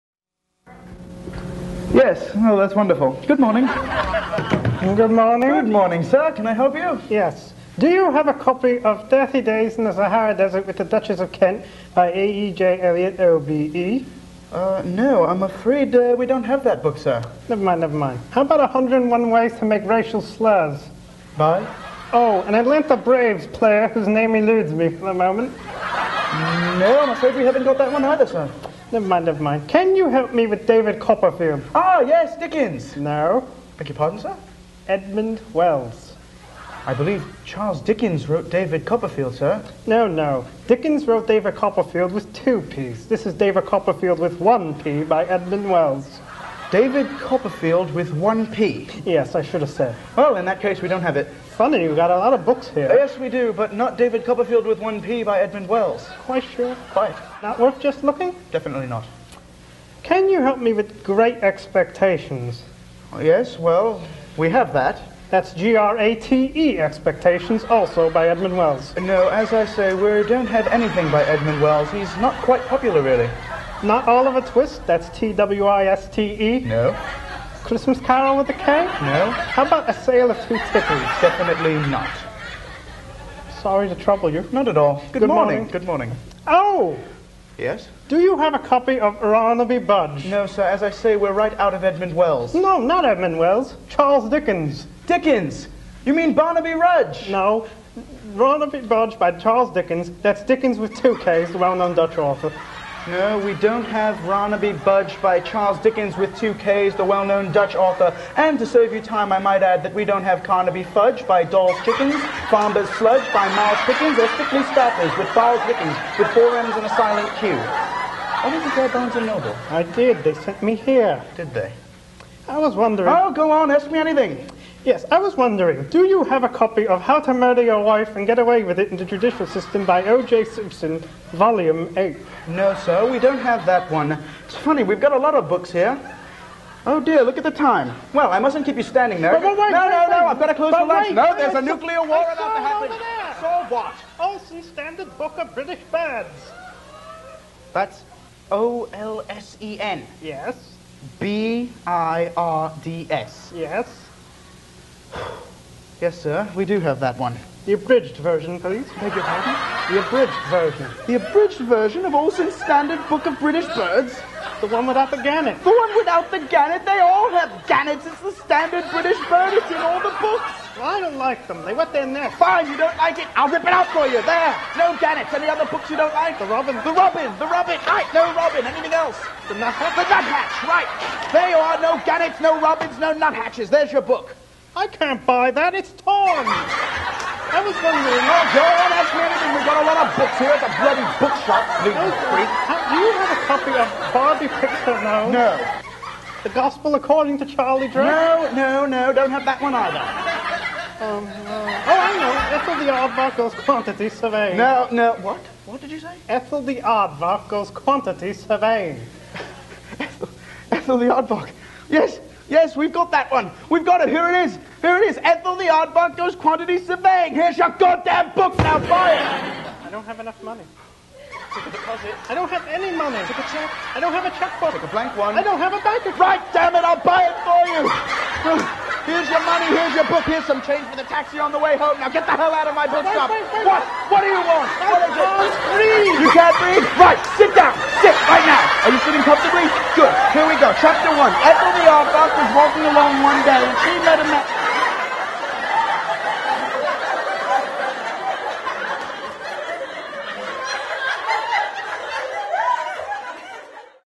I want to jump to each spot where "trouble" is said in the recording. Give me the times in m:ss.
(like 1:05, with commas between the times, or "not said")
1:23.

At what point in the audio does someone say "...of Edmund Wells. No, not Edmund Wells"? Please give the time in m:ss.
1:31.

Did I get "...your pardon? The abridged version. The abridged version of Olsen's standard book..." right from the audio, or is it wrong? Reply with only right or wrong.
right.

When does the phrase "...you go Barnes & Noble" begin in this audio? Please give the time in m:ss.
1:58.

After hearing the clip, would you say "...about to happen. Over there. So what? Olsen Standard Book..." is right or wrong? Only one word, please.
right.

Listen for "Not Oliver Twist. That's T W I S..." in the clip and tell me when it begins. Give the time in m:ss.
1:13.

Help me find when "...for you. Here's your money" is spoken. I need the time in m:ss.
3:47.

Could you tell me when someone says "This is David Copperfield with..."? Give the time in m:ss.
0:43.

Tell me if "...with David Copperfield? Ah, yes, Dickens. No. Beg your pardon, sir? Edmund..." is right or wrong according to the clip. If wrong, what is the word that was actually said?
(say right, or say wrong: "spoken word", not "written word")
right.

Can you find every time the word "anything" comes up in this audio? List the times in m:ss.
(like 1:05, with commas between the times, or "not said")
1:10, 2:03, 2:58, 3:09.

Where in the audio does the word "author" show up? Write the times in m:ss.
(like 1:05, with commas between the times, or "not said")
1:42, 1:47.